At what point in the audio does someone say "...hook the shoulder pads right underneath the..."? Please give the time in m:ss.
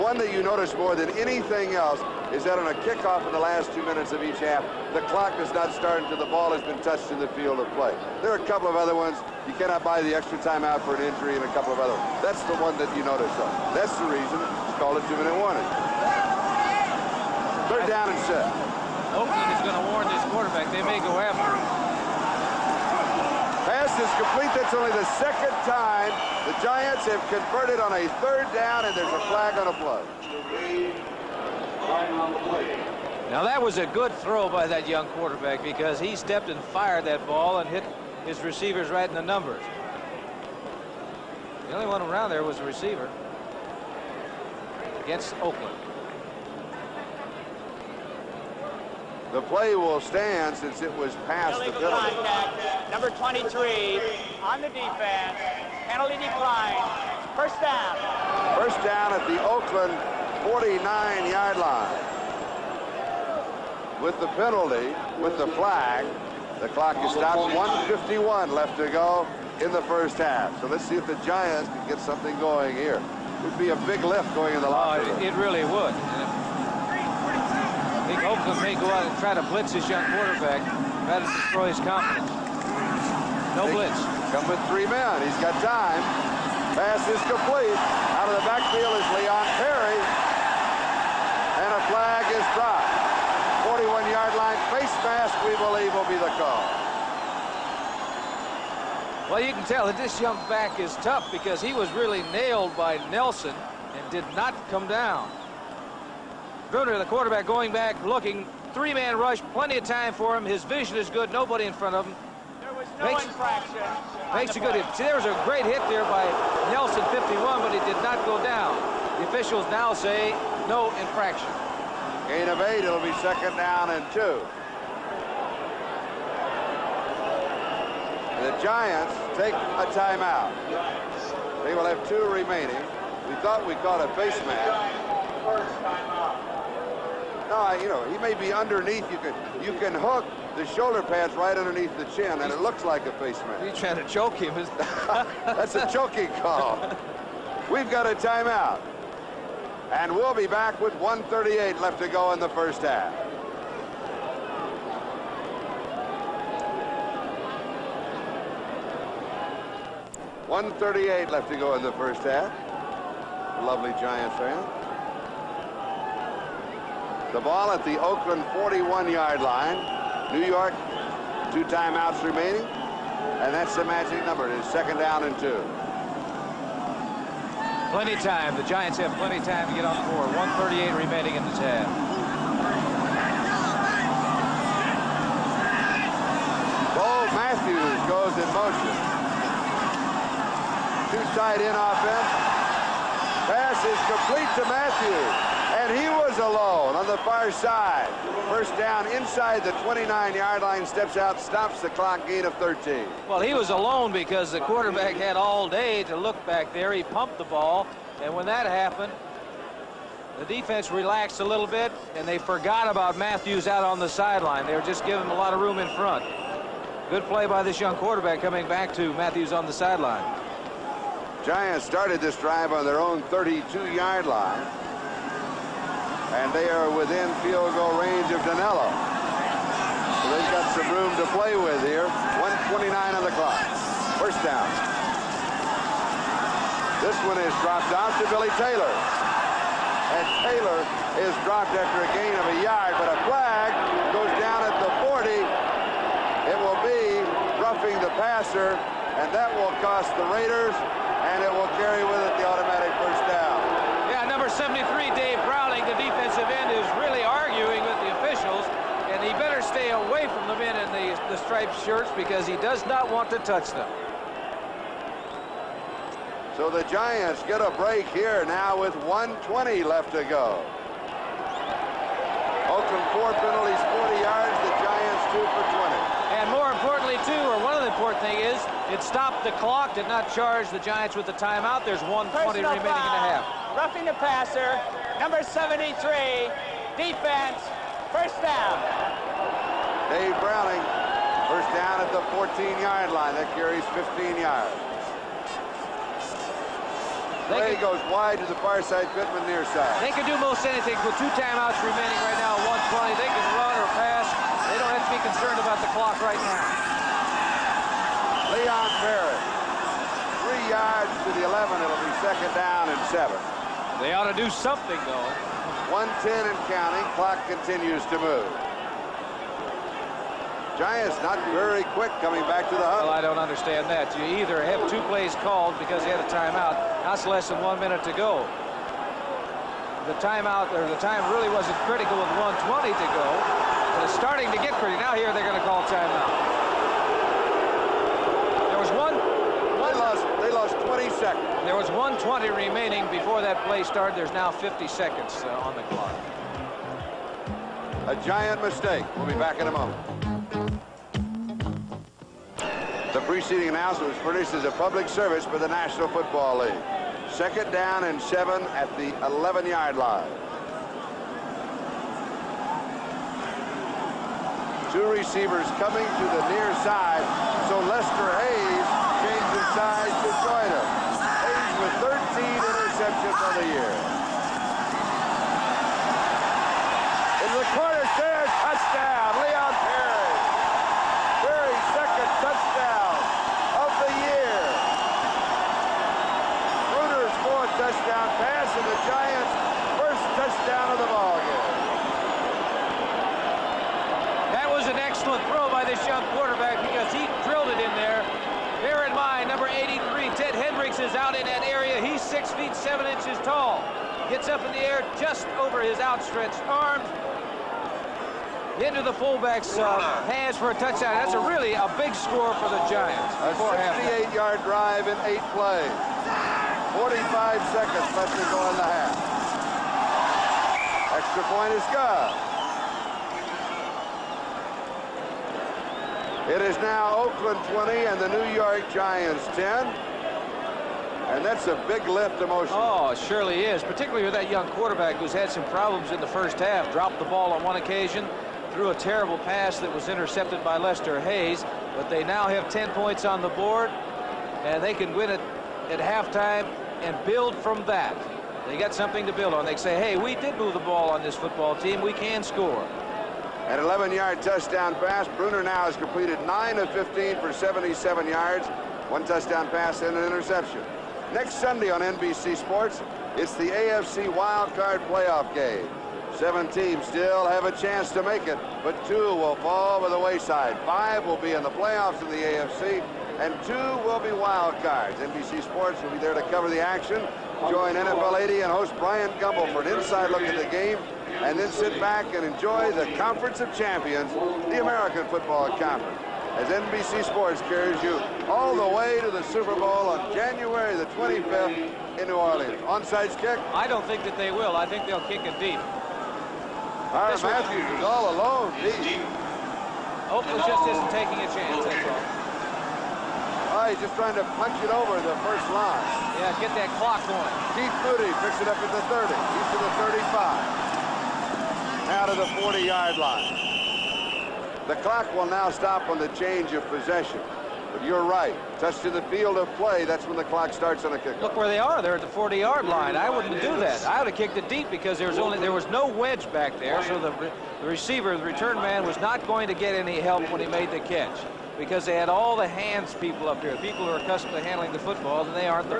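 2:19.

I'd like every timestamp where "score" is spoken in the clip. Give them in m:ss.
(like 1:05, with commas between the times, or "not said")
6:52, 7:32.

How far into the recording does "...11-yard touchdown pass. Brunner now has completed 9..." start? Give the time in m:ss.
7:33.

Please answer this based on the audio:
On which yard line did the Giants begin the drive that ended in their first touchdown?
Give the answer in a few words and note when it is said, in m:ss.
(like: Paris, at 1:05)
32-yard line, at 3:42.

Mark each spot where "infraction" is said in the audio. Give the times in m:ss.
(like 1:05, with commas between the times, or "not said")
1:53, 2:01.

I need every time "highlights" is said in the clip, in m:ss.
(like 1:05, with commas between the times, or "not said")
not said.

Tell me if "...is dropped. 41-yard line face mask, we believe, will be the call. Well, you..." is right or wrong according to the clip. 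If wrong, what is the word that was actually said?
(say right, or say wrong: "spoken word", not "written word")
right.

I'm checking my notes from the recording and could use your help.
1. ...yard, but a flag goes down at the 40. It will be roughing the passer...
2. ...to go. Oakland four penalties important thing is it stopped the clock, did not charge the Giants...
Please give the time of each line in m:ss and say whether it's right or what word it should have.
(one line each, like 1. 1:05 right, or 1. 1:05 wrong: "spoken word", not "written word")
1. 4:02 right
2. 4:30 right.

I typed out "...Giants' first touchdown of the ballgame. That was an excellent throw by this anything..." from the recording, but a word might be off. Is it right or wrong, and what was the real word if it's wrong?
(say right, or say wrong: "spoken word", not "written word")
wrong: "young", not "anything".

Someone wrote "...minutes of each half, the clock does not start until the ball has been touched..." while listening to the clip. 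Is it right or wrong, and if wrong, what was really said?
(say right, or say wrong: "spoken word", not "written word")
right.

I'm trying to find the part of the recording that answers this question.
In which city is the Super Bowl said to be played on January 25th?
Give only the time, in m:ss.
8:12.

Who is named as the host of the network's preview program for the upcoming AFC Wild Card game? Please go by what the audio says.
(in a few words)
Brian Gumbel.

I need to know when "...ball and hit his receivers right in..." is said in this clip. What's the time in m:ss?
0:37.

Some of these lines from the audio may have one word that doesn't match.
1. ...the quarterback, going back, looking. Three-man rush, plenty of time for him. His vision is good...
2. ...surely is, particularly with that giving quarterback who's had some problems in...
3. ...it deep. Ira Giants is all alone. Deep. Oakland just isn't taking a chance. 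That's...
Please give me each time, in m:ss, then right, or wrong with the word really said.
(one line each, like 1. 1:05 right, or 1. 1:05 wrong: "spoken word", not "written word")
1. 1:46 right
2. 7:13 wrong: "young", not "giving"
3. 8:15 wrong: "Matthews", not "Giants".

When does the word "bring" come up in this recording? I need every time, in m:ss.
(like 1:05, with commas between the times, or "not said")
not said.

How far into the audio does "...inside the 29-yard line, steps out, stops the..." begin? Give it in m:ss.
3:19.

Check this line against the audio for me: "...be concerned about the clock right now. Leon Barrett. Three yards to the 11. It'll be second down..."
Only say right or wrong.
right.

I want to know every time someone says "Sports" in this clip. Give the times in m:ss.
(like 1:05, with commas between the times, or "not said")
7:42, 7:55, 8:07.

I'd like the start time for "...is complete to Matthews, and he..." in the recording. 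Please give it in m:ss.
3:13.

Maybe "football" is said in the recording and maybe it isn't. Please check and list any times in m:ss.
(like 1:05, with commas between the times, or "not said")
5:56, 7:31, 8:05, 8:54.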